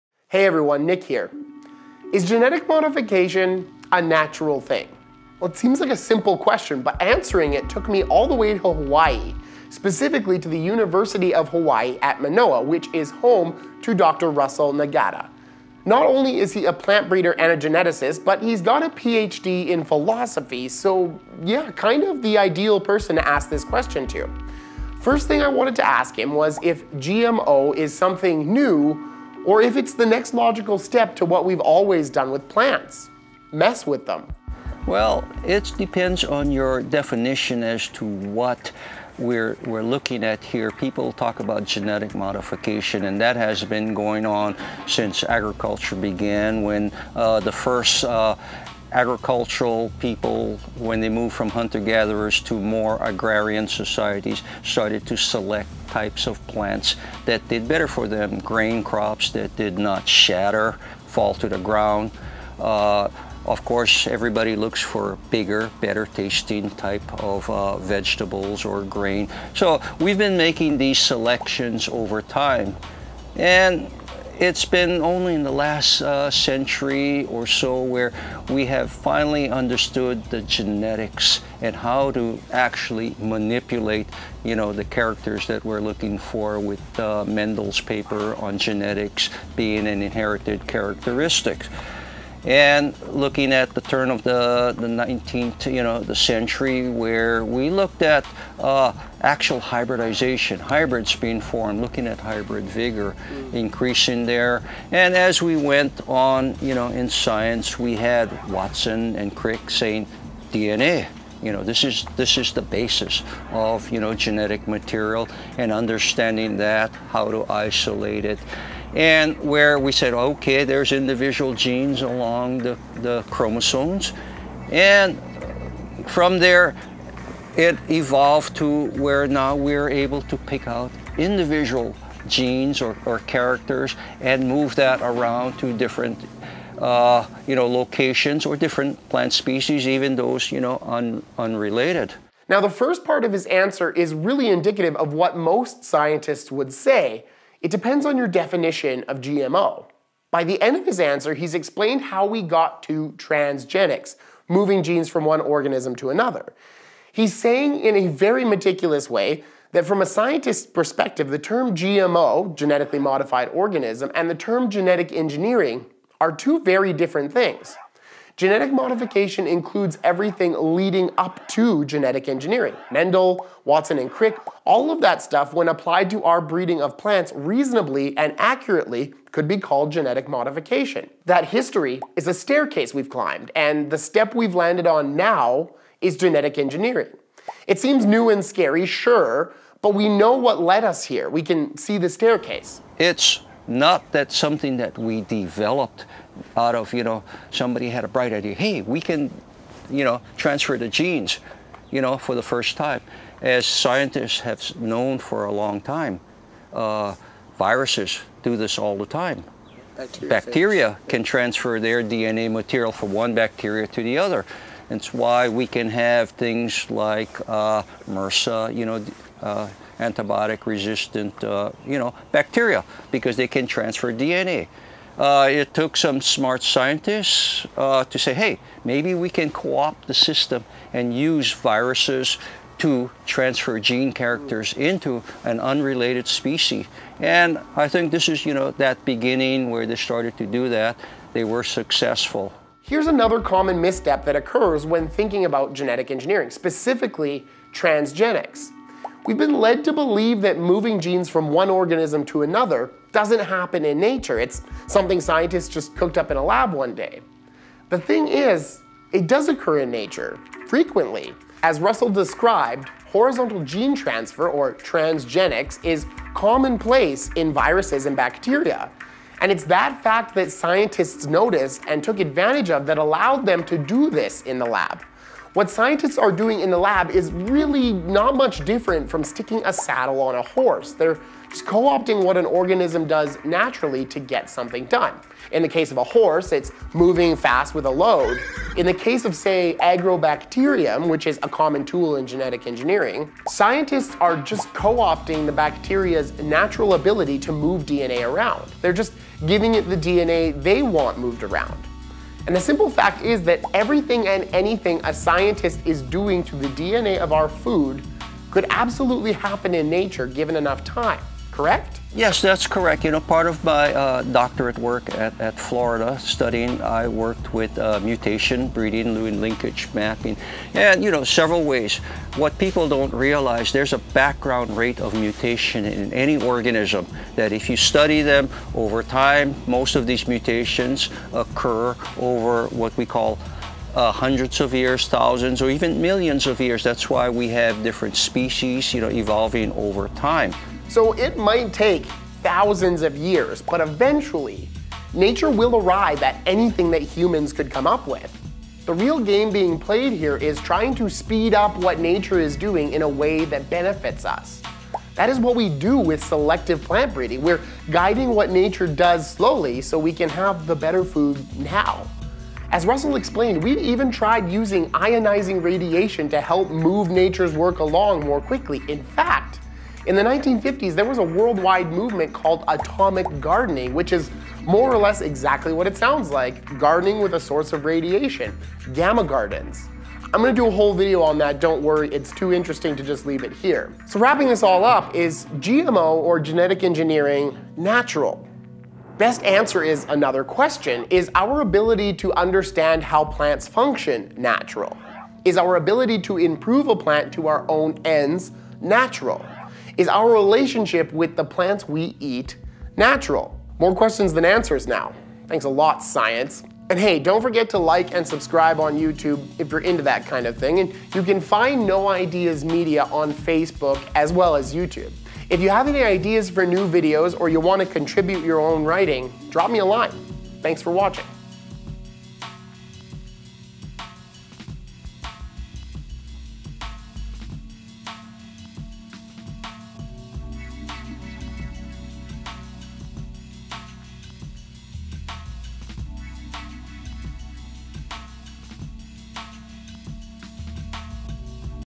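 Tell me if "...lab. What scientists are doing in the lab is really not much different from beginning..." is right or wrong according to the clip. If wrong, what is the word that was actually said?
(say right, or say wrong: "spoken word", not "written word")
wrong: "sticking", not "beginning".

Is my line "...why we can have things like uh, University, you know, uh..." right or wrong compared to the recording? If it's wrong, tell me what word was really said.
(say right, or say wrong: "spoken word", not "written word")
wrong: "MRSA", not "University".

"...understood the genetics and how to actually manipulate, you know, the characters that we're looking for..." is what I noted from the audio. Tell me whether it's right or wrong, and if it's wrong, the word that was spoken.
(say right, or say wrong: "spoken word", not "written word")
right.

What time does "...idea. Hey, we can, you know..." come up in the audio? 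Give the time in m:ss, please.
3:18.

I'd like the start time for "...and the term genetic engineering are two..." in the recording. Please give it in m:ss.
2:44.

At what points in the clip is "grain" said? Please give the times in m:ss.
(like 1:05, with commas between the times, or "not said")
0:58, 1:08.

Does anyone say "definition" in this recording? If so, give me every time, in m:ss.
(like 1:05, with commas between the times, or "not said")
0:36, 2:28.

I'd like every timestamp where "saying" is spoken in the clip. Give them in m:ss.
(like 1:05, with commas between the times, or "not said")
1:49, 2:37.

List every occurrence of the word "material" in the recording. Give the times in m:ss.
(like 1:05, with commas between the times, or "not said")
1:54, 3:32.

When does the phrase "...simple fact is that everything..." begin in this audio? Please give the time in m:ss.
5:02.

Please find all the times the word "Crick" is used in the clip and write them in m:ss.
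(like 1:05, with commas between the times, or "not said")
1:49, 2:54.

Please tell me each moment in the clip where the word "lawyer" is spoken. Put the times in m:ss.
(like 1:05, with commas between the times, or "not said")
not said.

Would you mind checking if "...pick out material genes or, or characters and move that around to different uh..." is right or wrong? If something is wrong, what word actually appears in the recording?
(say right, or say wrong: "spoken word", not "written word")
wrong: "individual", not "material".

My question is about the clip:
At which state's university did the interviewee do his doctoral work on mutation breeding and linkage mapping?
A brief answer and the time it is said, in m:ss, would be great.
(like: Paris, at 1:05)
Florida, at 5:15.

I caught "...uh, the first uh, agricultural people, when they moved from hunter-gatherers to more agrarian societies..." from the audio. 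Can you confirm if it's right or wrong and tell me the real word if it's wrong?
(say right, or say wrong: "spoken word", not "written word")
right.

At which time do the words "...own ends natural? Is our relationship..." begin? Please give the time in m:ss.
6:37.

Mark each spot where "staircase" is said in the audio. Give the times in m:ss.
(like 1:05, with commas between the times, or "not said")
3:02, 3:12.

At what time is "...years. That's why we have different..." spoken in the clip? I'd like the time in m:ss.
5:36.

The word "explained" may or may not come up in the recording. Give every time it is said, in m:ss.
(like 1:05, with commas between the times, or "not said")
2:31, 6:03.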